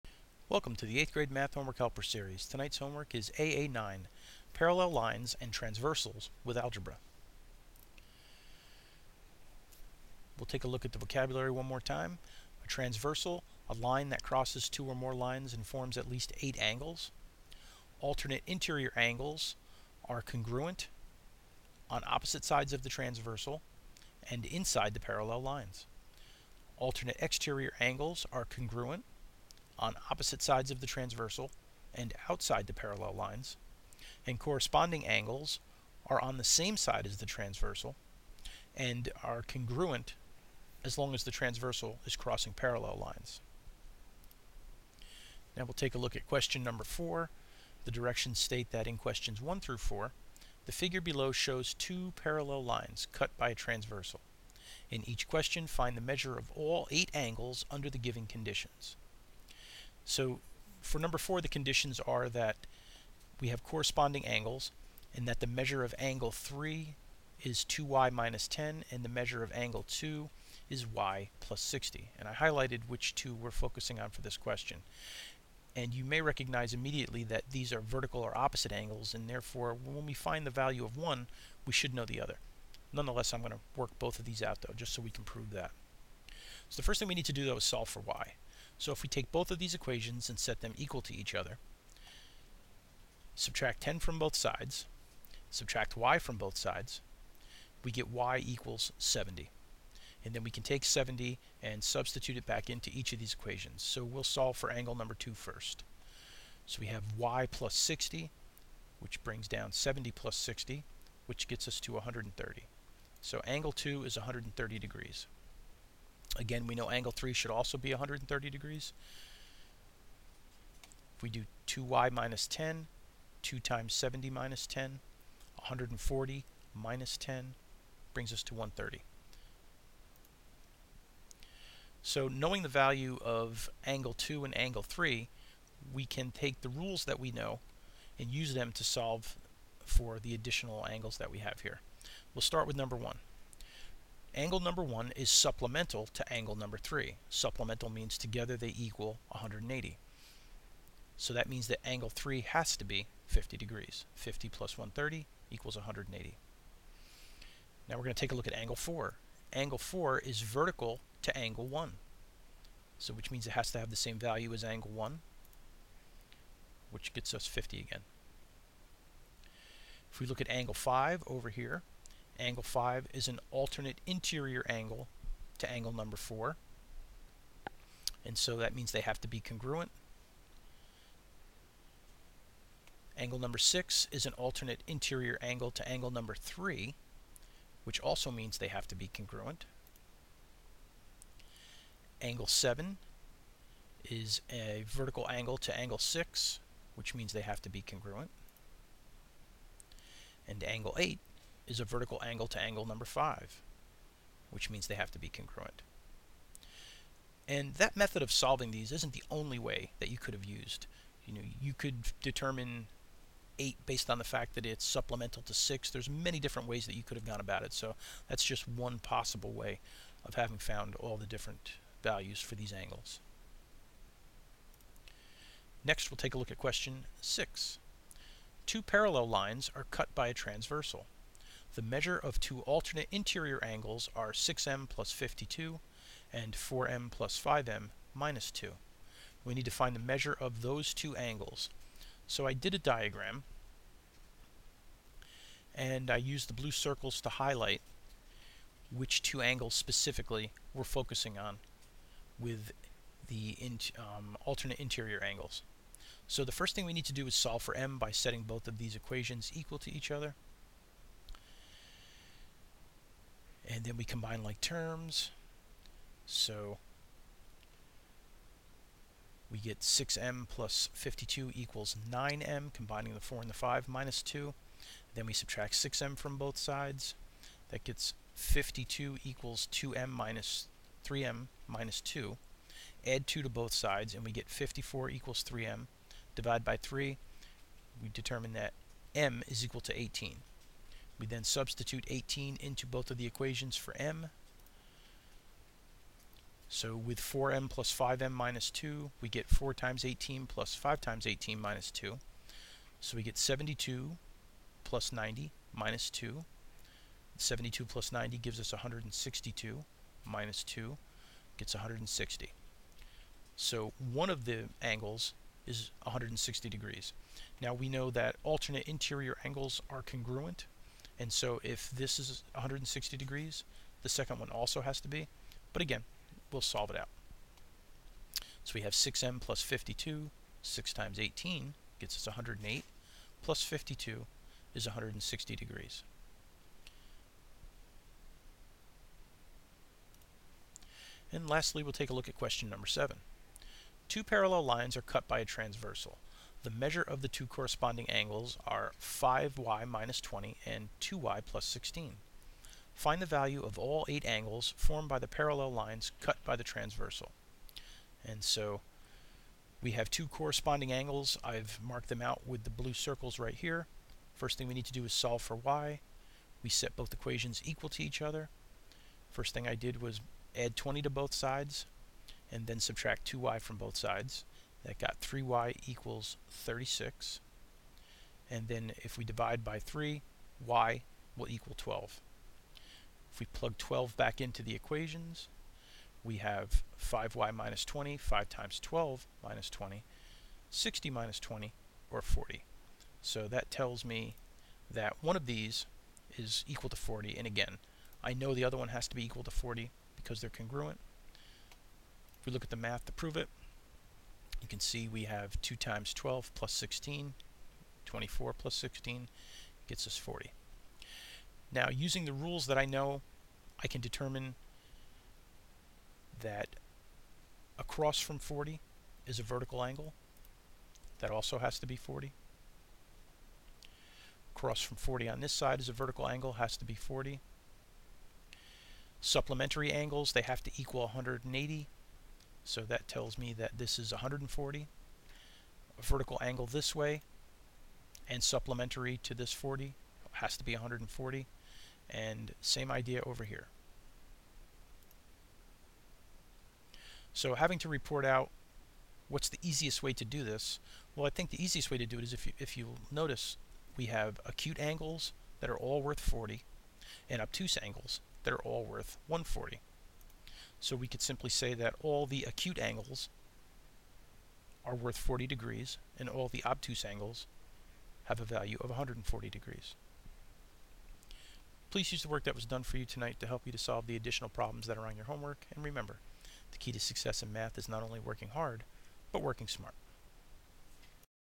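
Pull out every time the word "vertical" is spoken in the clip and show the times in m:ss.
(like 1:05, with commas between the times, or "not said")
1:17, 2:40, 3:14, 3:21, 6:59, 7:05, 7:16.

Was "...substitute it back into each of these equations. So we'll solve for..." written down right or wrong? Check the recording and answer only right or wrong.
right.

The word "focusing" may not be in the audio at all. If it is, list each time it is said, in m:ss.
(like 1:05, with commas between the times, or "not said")
1:13, 4:10.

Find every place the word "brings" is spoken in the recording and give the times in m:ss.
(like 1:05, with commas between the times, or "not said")
1:49, 2:08.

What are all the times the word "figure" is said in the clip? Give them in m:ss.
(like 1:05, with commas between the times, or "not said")
0:50.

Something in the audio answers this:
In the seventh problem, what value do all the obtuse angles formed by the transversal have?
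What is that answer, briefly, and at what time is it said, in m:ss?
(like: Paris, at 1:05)
140 degrees, at 7:48.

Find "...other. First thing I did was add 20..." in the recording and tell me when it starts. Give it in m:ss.
6:08.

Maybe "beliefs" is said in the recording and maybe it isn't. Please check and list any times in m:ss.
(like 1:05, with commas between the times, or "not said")
not said.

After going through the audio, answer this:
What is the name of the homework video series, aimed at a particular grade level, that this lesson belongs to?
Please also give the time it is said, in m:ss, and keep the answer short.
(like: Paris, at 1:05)
Math Homework Helper Series, at 0:01.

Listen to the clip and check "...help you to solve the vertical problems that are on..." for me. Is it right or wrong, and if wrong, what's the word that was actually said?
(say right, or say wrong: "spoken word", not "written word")
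wrong: "additional", not "vertical".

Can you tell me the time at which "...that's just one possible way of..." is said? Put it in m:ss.
3:38.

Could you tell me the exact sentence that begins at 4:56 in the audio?
So with 4m plus 5m minus 2, we get 4 times 18 plus 5 times 18 minus 2.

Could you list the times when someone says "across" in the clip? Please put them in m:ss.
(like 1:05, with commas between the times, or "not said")
6:57, 7:04.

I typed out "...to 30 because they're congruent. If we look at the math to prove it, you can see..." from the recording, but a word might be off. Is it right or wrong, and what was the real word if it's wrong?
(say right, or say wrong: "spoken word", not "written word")
wrong: "40", not "30".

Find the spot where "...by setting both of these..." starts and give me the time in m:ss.
4:17.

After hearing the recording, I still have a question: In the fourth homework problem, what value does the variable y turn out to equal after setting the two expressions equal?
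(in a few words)
70.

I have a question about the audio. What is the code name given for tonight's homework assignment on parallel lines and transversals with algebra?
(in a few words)
AA9.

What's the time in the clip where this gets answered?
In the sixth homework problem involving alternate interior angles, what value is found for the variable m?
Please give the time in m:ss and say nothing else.
4:49.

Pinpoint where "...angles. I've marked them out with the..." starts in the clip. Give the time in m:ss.
6:00.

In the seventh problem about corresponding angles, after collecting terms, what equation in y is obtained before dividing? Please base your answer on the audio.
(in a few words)
3y = 36.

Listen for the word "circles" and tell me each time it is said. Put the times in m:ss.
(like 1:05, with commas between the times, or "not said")
4:06, 6:02.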